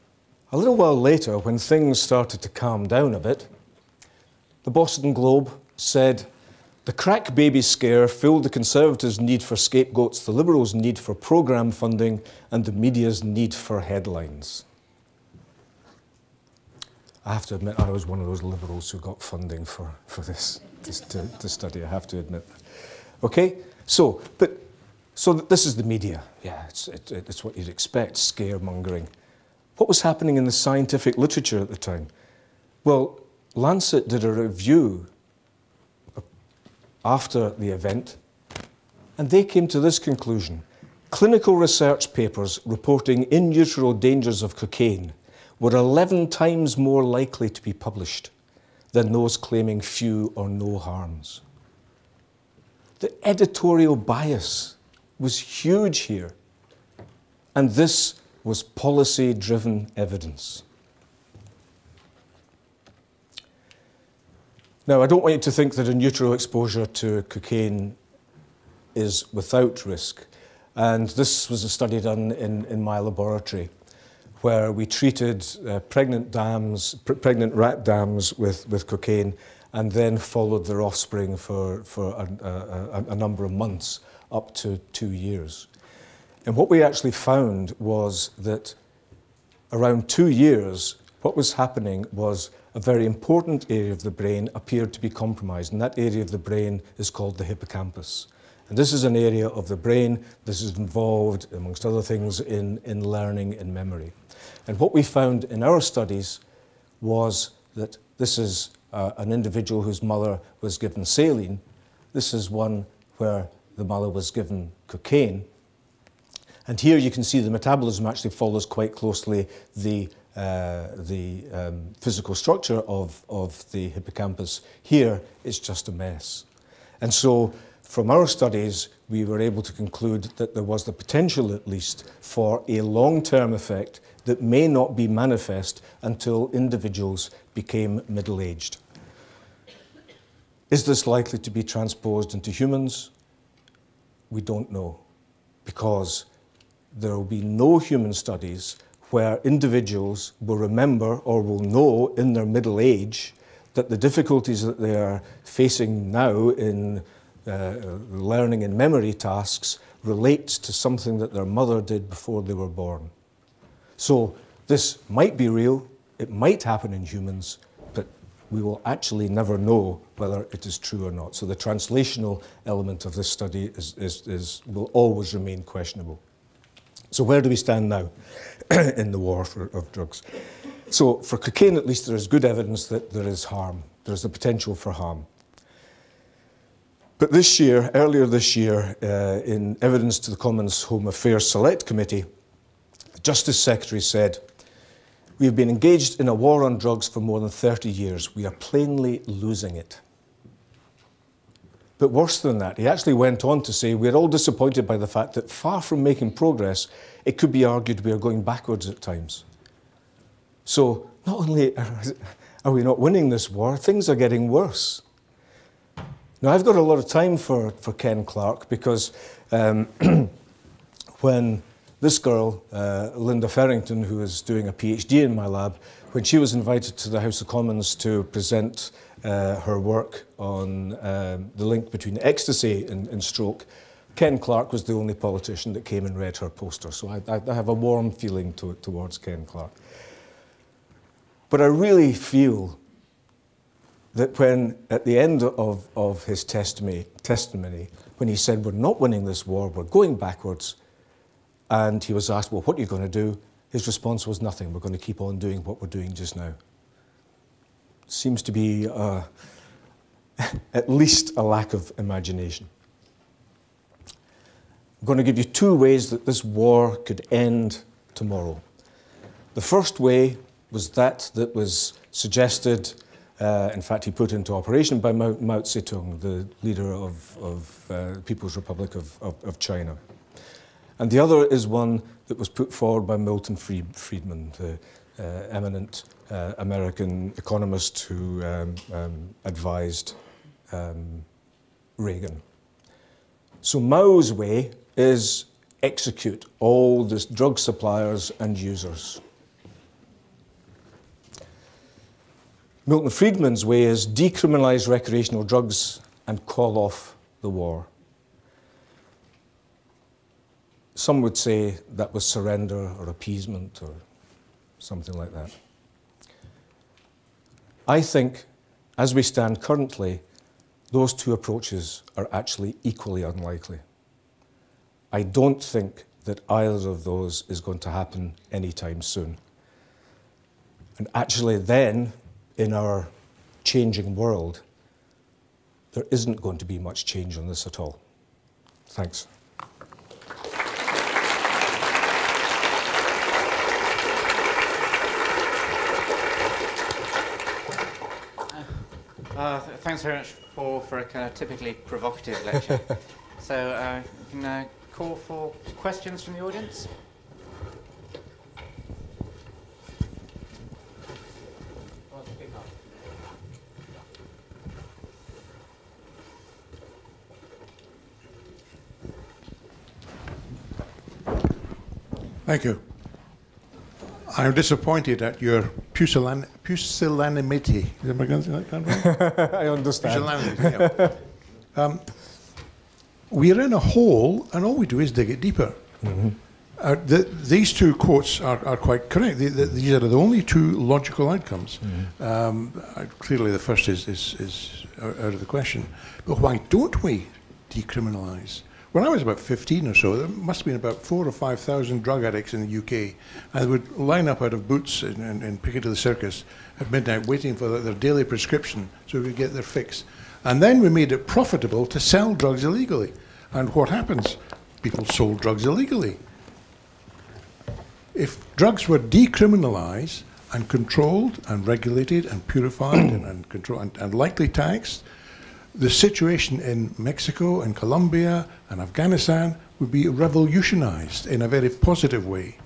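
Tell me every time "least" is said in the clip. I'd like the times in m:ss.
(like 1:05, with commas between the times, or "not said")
2:11, 3:01, 4:20.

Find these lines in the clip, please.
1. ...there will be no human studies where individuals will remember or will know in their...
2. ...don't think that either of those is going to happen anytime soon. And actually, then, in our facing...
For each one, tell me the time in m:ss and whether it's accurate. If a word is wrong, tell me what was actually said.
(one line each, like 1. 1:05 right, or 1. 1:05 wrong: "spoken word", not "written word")
1. 2:26 right
2. 5:25 wrong: "changing", not "facing".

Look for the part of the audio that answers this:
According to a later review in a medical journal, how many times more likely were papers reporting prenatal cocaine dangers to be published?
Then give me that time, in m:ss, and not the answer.
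0:45.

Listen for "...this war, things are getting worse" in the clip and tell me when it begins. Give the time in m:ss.
3:33.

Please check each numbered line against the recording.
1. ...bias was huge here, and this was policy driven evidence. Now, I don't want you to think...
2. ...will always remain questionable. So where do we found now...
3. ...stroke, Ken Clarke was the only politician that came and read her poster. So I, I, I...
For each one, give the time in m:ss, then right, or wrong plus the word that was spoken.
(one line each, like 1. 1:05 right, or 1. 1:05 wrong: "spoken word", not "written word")
1. 0:53 right
2. 2:54 wrong: "stand", not "found"
3. 3:53 right.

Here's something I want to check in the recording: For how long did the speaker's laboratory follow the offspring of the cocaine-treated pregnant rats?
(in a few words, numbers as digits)
up to two years.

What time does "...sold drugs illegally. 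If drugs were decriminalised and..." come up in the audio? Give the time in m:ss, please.
6:55.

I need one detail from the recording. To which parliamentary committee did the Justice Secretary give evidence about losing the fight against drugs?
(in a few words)
Commons Home Affairs Select Committee.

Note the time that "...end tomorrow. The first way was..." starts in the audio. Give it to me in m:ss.
4:27.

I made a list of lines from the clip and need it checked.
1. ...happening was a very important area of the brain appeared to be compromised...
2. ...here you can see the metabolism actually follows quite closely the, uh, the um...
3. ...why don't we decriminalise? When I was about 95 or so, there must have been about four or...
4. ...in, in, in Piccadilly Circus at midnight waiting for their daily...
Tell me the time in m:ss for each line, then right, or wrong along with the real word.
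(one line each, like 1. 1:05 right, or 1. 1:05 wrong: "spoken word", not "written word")
1. 1:31 right
2. 1:56 right
3. 6:36 wrong: "15", not "95"
4. 6:45 right.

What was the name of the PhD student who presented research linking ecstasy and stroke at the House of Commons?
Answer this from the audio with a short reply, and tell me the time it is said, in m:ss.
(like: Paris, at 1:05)
Linda Farrington, at 3:43.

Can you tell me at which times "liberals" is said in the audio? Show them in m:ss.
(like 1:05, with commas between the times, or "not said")
0:10, 0:18.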